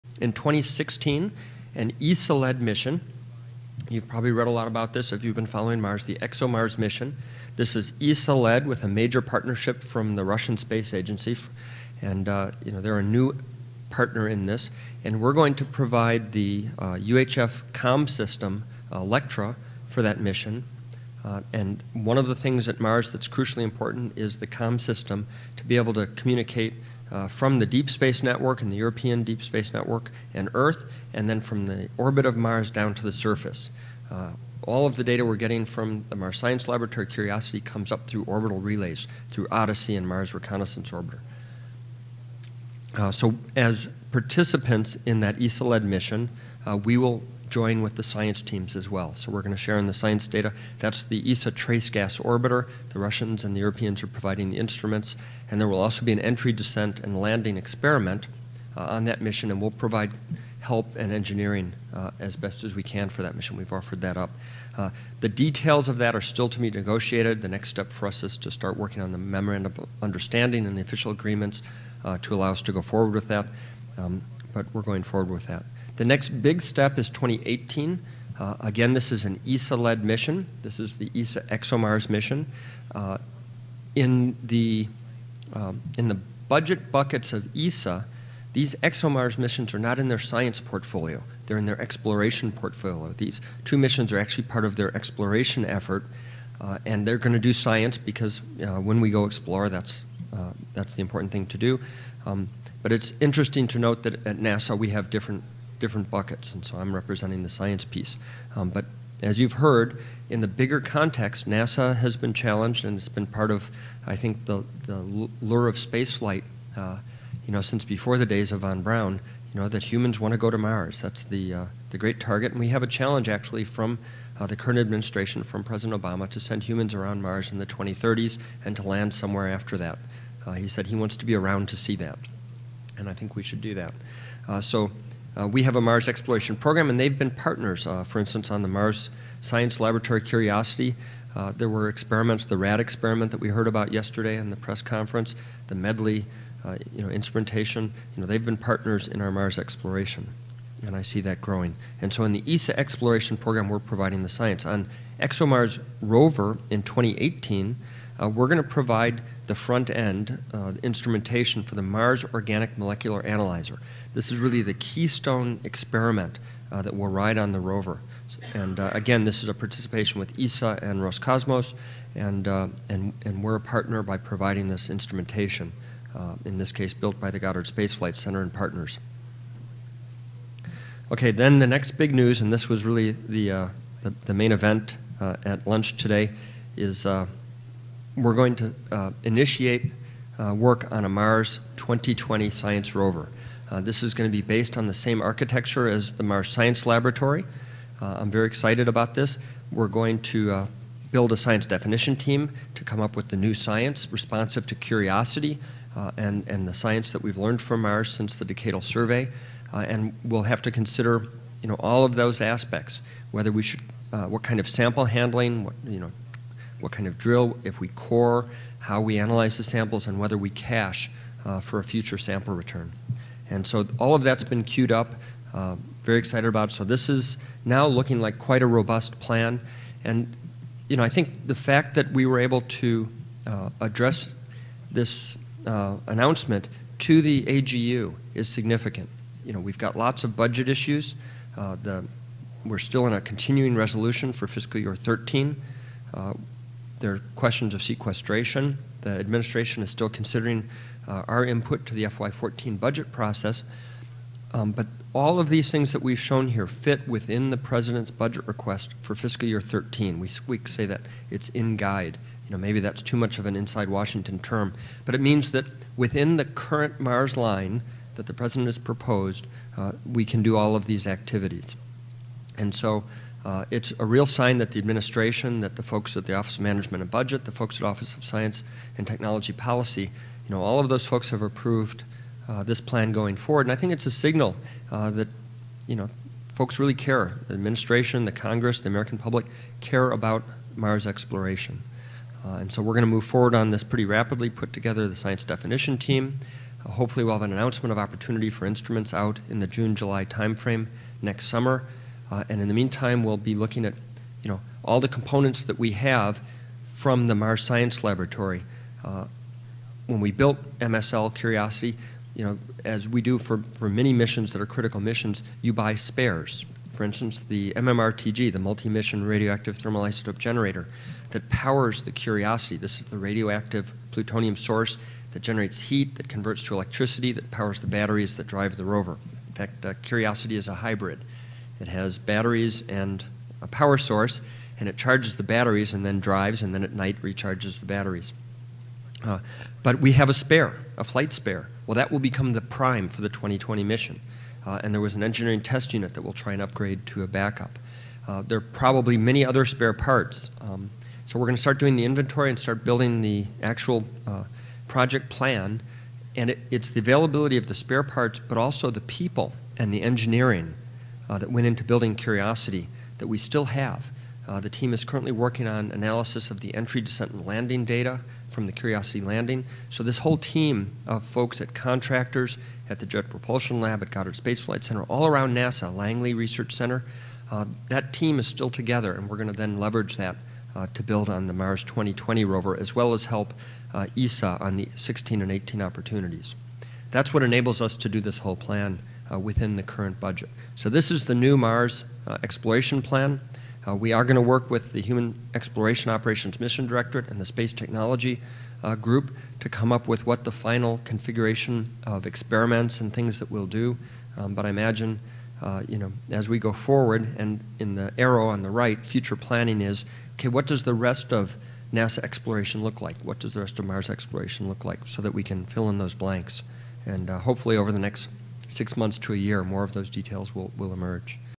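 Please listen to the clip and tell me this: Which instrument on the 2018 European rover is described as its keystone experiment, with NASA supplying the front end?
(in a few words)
Mars Organic Molecular Analyzer.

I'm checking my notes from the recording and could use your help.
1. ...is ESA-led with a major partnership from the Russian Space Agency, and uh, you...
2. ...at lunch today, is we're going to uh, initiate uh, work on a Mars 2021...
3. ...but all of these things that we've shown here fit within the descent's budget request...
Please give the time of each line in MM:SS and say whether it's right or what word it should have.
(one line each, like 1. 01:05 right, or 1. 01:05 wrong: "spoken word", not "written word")
1. 00:07 right
2. 03:05 wrong: "2020", not "2021"
3. 04:14 wrong: "president", not "descent".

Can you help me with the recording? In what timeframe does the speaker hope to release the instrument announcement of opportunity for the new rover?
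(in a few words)
June-July.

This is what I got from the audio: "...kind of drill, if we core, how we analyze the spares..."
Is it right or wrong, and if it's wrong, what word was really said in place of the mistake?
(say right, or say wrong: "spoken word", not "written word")
wrong: "samples", not "spares".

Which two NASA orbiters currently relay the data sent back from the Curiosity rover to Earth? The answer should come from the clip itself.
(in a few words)
Odyssey and Mars Reconnaissance Orbiter.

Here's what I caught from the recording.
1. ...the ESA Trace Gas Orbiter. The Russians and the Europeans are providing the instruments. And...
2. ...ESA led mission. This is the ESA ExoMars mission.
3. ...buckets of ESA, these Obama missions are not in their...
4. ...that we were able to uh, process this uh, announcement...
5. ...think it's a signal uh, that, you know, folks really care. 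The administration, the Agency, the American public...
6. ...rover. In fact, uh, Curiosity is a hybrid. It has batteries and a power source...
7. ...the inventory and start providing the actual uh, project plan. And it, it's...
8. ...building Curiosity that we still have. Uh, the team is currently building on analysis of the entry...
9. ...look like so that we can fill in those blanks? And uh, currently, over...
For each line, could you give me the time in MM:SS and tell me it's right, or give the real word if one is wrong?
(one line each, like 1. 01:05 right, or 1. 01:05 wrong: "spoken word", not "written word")
1. 00:51 right
2. 01:19 right
3. 01:26 wrong: "ExoMars", not "Obama"
4. 03:51 wrong: "address", not "process"
5. 04:43 wrong: "Congress", not "Agency"
6. 05:28 right
7. 05:51 wrong: "building", not "providing"
8. 06:01 wrong: "working", not "building"
9. 06:54 wrong: "hopefully", not "currently".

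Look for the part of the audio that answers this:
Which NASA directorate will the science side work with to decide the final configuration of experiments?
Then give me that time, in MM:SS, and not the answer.
06:35.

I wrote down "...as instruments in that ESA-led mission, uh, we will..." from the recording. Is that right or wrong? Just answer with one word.
wrong.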